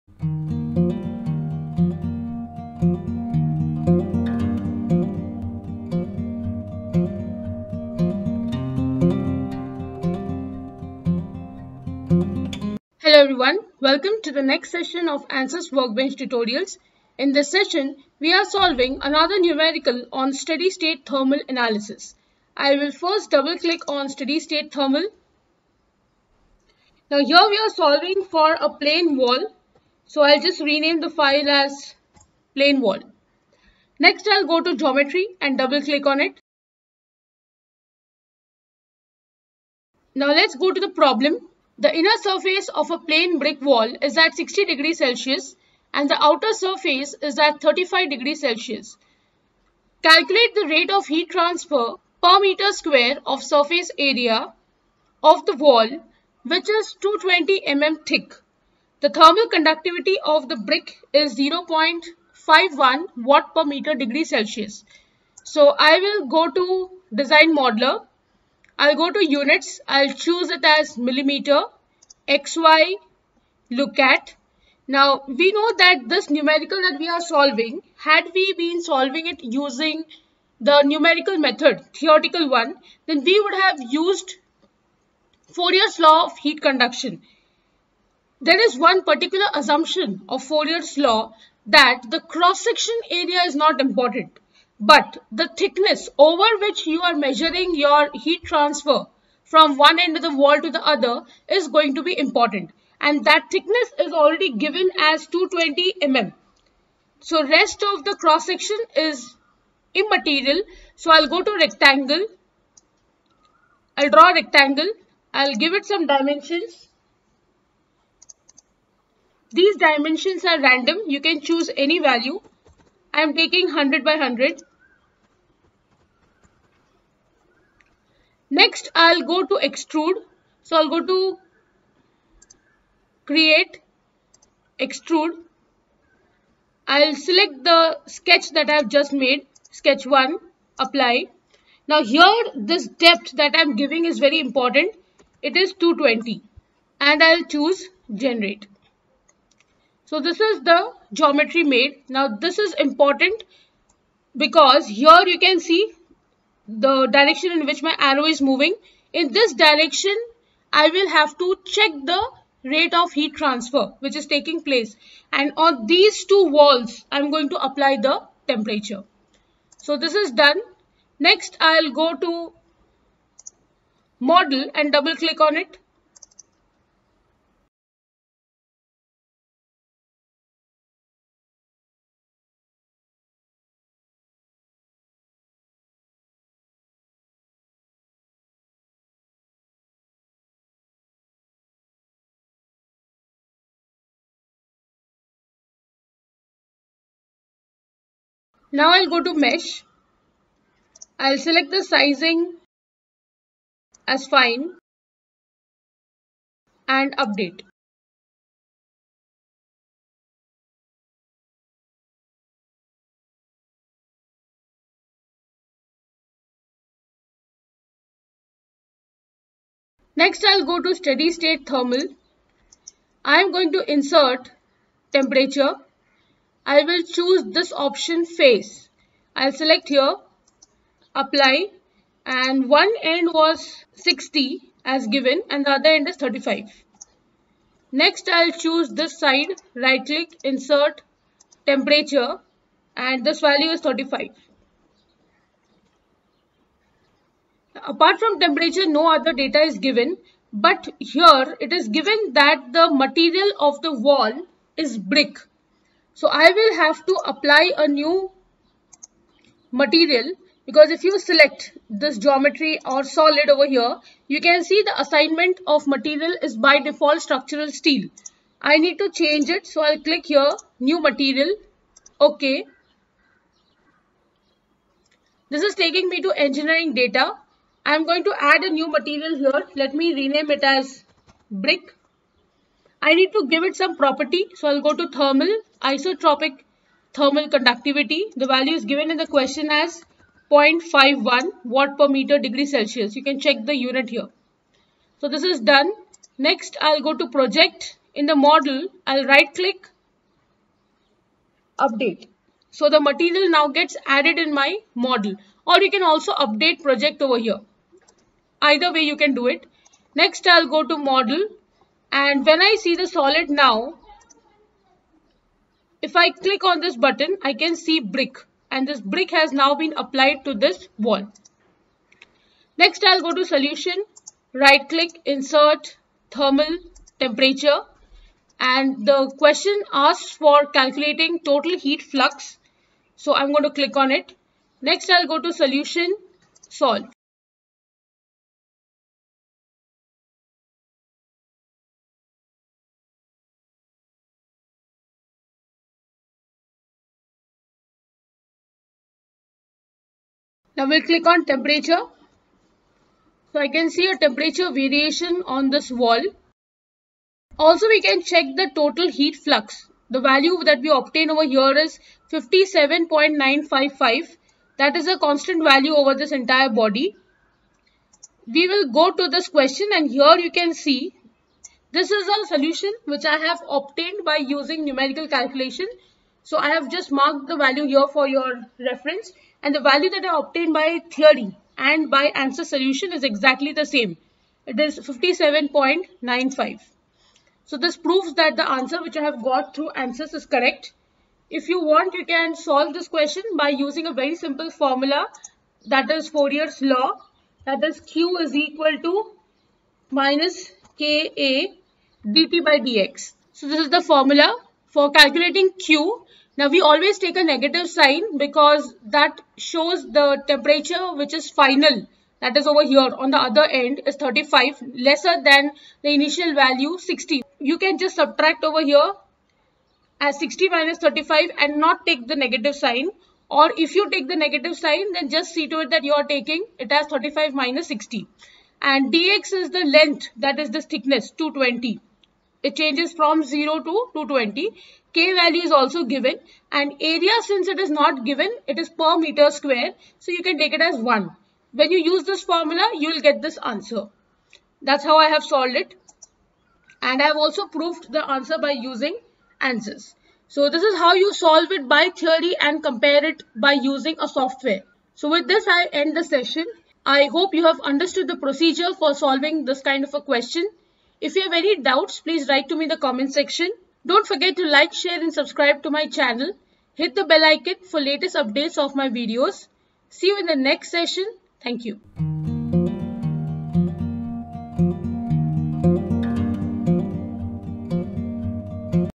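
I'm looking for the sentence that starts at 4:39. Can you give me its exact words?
Let me rename it as brick.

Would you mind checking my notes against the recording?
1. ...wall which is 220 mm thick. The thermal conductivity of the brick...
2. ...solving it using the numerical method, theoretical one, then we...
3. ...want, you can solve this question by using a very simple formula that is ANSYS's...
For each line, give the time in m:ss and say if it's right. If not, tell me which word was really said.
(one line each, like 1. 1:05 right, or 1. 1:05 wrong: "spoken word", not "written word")
1. 0:55 right
2. 1:18 right
3. 6:31 wrong: "Fourier", not "ANSYS".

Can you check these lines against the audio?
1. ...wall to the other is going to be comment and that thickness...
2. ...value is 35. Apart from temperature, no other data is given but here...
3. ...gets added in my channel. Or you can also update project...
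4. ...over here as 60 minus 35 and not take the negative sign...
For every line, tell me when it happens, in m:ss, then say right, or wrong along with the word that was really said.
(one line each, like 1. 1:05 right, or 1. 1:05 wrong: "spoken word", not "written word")
1. 1:40 wrong: "important", not "comment"
2. 4:03 right
3. 5:03 wrong: "model", not "channel"
4. 6:58 right.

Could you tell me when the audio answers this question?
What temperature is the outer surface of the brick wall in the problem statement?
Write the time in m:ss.
0:47.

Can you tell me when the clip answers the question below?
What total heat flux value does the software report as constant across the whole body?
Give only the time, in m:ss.
6:02.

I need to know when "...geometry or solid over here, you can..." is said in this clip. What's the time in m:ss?
4:22.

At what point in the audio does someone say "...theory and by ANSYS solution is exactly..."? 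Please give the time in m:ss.
6:21.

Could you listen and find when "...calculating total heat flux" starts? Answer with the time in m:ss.
5:30.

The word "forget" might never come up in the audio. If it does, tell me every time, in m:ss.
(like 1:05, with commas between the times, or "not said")
7:44.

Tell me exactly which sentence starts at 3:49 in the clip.
I'll select here, apply and one end was 60 as given and the other end is 35.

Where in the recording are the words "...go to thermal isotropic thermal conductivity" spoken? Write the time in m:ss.
4:44.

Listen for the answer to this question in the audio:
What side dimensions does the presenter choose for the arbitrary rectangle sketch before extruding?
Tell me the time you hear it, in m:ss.
2:03.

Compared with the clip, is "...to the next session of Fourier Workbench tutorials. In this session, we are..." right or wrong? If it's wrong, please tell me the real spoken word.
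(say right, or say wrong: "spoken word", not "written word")
wrong: "ANSYS", not "Fourier".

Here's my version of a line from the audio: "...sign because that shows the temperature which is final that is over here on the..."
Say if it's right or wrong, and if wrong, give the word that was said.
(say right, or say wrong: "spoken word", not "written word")
right.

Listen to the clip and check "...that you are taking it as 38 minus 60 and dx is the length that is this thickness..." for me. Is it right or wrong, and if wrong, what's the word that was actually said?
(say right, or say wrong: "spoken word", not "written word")
wrong: "35", not "38".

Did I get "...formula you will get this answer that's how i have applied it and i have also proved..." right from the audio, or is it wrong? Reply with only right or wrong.
wrong.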